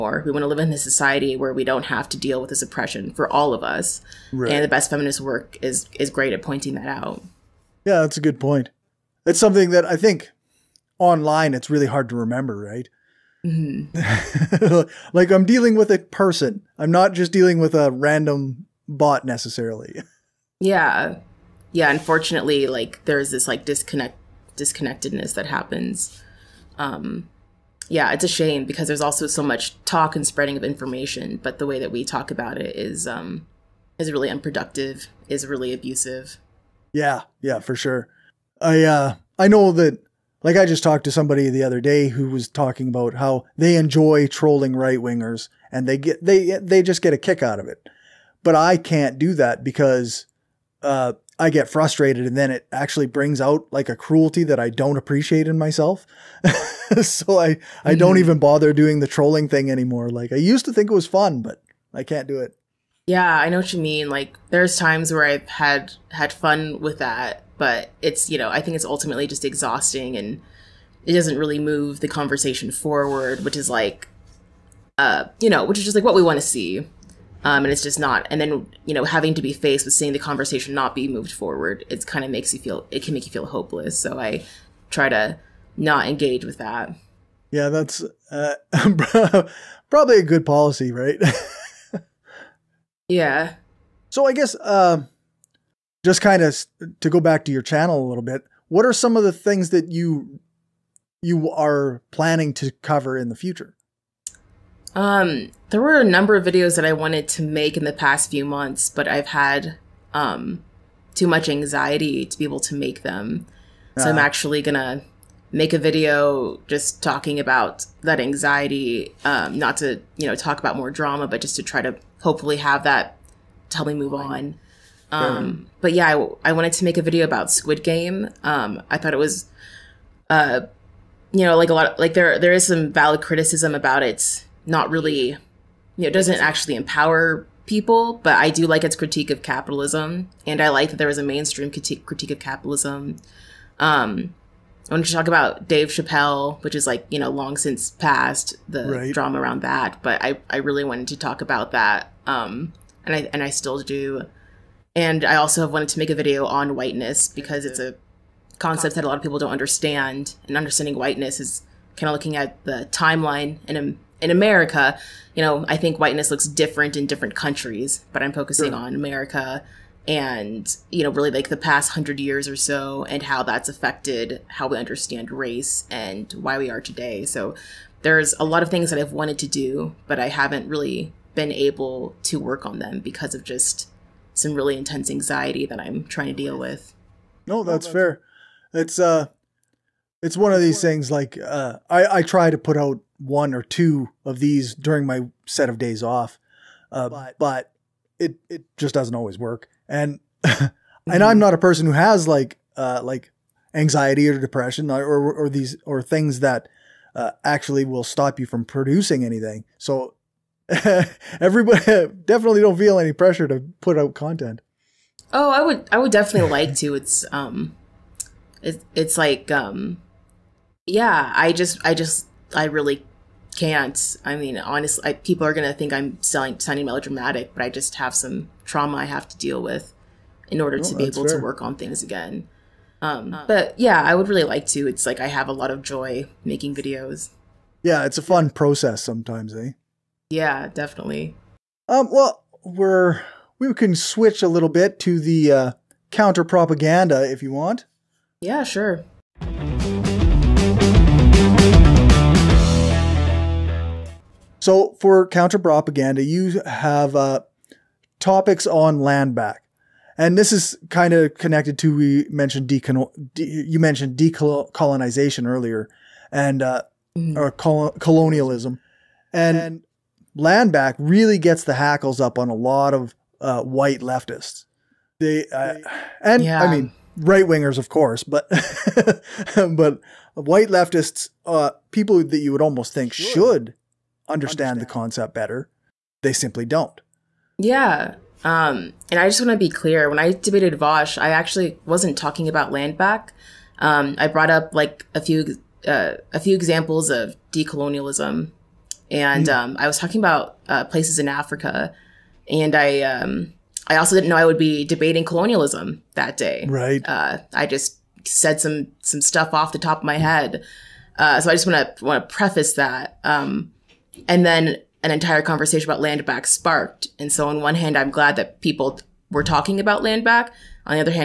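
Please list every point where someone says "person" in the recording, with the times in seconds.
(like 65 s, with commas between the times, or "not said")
15 s, 201 s.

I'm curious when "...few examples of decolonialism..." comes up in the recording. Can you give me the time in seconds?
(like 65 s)
296 s.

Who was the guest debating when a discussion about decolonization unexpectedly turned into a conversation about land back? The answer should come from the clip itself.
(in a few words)
Vosh.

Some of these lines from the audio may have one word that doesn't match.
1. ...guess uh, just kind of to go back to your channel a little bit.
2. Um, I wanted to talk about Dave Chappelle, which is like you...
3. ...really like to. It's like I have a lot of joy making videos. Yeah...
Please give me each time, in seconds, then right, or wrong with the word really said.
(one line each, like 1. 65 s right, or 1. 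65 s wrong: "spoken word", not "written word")
1. 94 s right
2. 143 s right
3. 234 s right.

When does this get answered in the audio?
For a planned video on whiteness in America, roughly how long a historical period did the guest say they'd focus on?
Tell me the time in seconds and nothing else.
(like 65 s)
171 s.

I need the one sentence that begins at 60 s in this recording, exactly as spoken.
Like I used to think it was fun, but I can't do it.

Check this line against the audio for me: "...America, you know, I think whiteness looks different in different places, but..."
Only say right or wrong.
wrong.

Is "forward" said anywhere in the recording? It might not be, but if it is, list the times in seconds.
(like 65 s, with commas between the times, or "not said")
72 s, 81 s.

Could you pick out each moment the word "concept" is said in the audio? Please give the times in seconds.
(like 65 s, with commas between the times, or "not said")
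158 s, 284 s.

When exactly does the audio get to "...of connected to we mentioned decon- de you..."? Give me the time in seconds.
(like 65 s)
261 s.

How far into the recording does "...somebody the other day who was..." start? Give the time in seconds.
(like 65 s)
41 s.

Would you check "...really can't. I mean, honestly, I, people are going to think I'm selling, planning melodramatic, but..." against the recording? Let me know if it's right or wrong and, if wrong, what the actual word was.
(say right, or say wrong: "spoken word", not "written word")
wrong: "sounding", not "planning".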